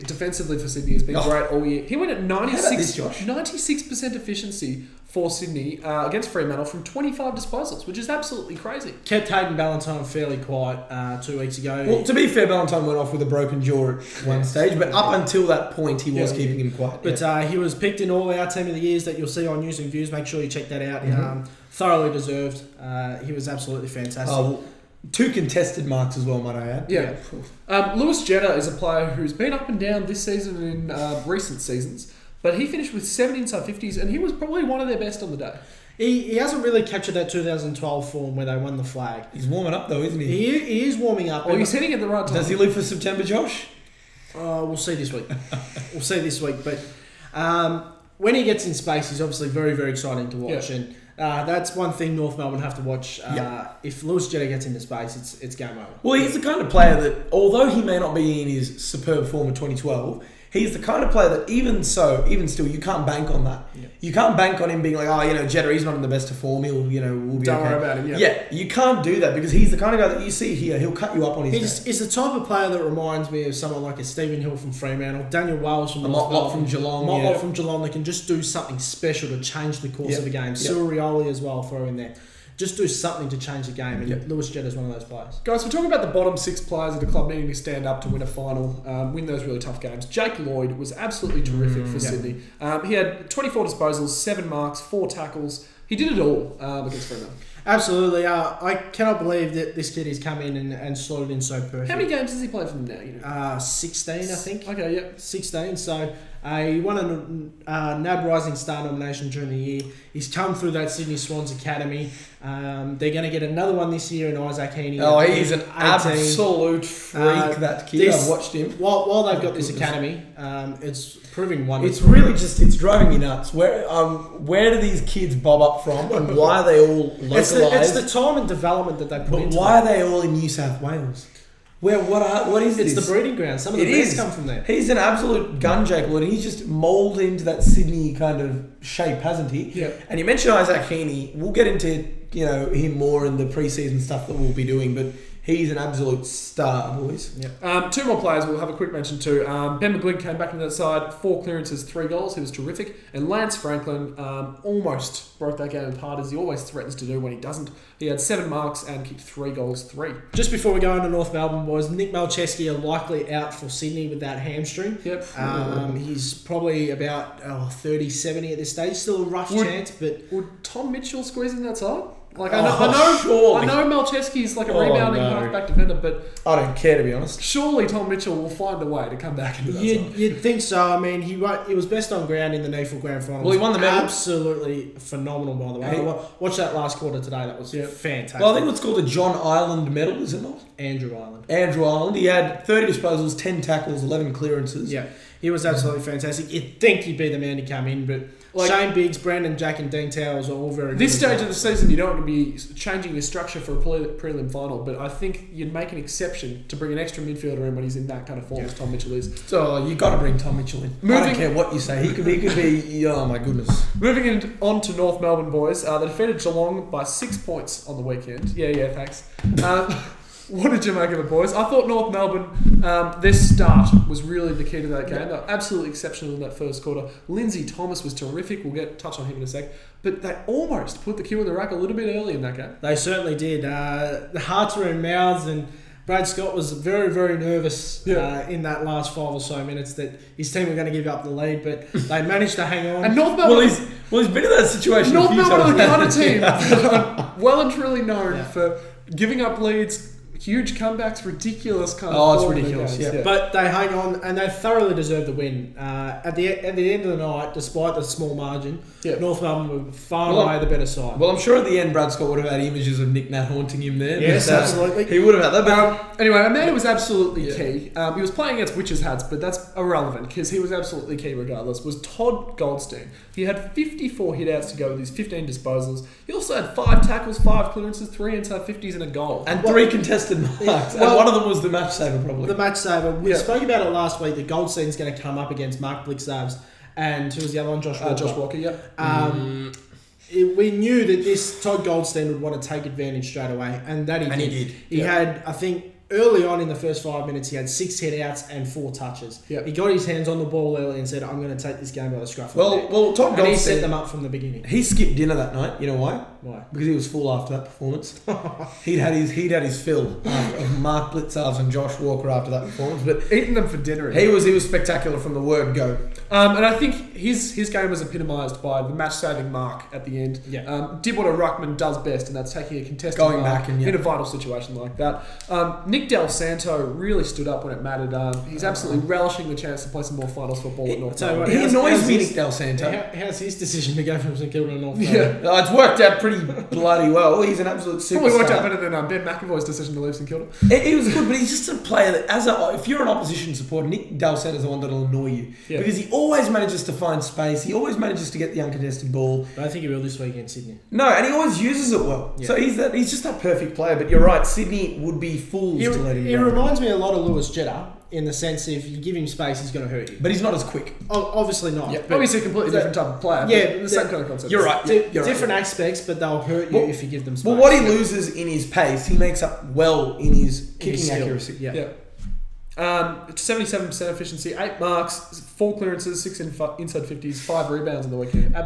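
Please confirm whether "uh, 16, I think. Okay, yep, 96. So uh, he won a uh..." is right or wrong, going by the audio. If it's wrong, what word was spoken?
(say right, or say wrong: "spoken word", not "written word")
wrong: "16", not "96".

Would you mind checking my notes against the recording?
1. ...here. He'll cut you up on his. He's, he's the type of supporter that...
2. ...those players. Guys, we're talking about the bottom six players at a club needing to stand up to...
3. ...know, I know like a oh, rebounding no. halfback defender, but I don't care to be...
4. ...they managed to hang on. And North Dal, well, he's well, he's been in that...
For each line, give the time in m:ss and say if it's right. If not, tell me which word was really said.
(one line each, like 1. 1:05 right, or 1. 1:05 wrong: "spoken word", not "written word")
1. 1:10 wrong: "player", not "supporter"
2. 1:24 right
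3. 2:53 right
4. 4:01 wrong: "Melbourne", not "Dal".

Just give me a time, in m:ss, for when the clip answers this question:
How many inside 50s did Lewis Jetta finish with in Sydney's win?
0:33.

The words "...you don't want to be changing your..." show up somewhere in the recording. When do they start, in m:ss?
3:21.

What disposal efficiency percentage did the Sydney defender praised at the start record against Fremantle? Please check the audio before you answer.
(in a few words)
96%.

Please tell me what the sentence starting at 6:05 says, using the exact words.
aspects, but they'll hurt you well, if you give them space.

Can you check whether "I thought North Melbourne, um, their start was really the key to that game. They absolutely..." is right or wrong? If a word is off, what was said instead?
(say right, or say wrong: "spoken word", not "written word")
right.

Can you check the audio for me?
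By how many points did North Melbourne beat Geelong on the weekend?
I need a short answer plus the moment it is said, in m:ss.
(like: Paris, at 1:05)
6, at 3:37.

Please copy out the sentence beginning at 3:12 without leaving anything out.
He had thirty disposals, ten tackles, eleven clearances.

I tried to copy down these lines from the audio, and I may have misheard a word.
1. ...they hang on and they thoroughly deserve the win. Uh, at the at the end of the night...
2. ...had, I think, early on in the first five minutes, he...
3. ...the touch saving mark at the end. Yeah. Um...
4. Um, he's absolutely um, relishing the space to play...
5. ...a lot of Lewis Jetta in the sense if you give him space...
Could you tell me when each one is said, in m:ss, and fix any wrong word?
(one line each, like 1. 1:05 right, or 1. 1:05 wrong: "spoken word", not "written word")
1. 4:13 right
2. 4:54 right
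3. 5:18 wrong: "match", not "touch"
4. 5:28 wrong: "chance", not "space"
5. 5:56 right.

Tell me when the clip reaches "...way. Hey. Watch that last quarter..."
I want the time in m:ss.
3:05.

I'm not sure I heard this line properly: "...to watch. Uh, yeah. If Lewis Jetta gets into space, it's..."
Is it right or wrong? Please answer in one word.
right.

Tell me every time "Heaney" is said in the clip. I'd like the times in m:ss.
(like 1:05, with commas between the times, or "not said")
1:54, 2:20.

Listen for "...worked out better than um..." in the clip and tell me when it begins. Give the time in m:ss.
5:38.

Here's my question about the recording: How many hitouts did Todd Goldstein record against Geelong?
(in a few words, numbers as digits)
54.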